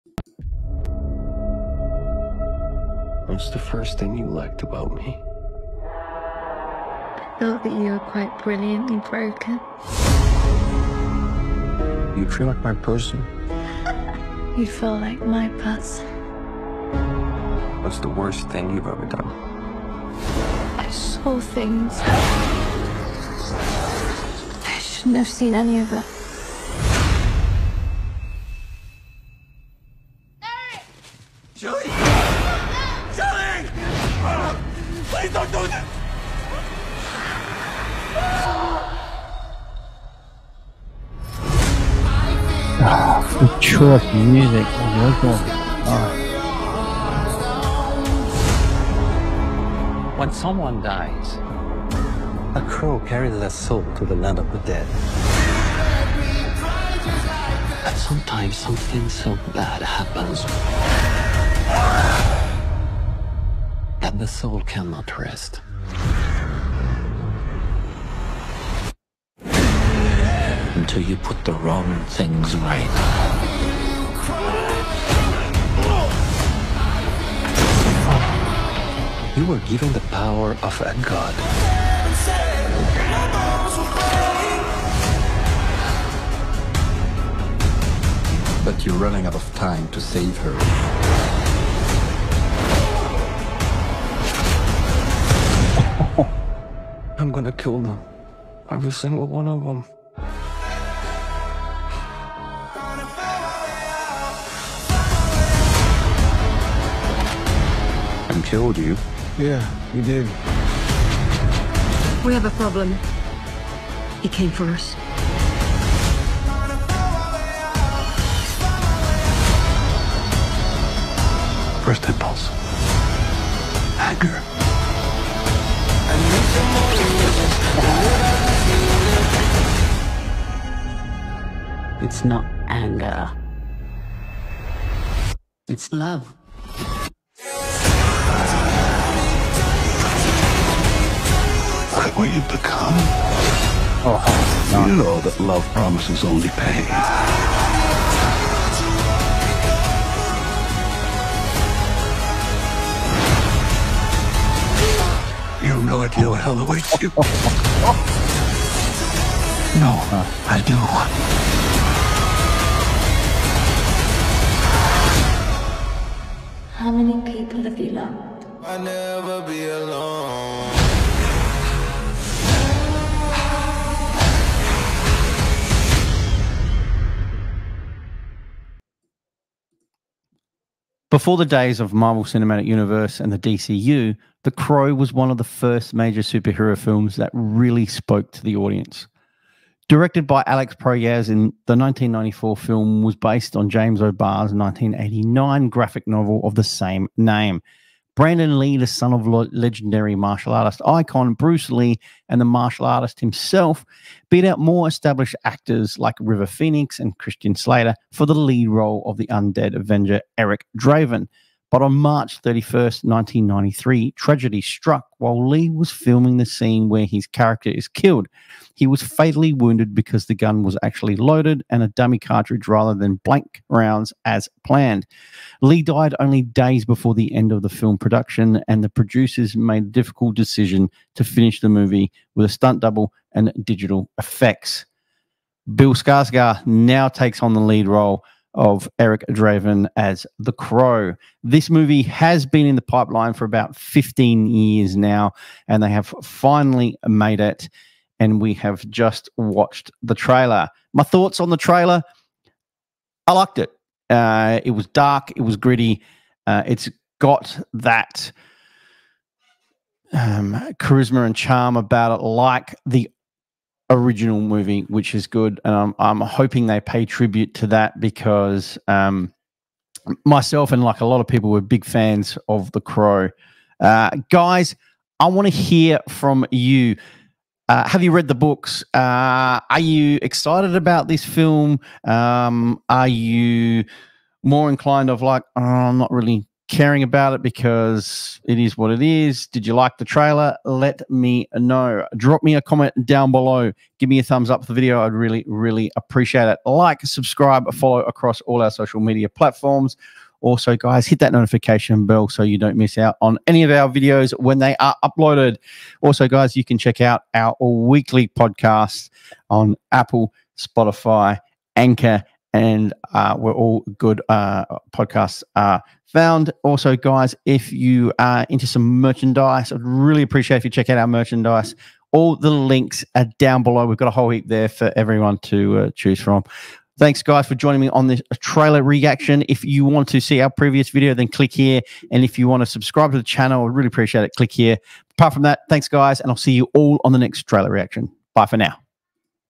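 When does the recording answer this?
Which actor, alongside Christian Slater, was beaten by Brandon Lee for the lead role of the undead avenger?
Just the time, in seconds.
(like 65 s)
206 s.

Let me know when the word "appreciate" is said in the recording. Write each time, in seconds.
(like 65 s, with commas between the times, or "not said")
295 s, 320 s, 333 s.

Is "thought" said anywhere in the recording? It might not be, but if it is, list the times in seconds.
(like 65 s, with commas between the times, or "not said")
7 s, 251 s.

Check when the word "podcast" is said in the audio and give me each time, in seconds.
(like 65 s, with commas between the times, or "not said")
308 s, 314 s.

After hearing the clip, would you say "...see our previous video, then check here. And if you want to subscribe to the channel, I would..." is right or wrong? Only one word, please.
wrong.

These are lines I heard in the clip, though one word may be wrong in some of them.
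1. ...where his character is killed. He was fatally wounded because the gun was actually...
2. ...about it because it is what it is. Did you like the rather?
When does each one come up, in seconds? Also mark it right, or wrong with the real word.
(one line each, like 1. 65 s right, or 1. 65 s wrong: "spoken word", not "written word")
1. 216 s right
2. 287 s wrong: "trailer", not "rather".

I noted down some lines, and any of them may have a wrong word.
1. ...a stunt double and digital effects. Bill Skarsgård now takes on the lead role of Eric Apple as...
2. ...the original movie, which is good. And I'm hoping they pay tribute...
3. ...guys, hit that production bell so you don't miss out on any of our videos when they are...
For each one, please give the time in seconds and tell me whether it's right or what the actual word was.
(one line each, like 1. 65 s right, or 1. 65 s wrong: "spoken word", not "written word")
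1. 232 s wrong: "Draven", not "Apple"
2. 262 s right
3. 300 s wrong: "notification", not "production".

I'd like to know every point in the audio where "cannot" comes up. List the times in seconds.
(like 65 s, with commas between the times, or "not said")
64 s.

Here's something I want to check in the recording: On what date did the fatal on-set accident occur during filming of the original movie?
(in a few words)
March 31st, 1993.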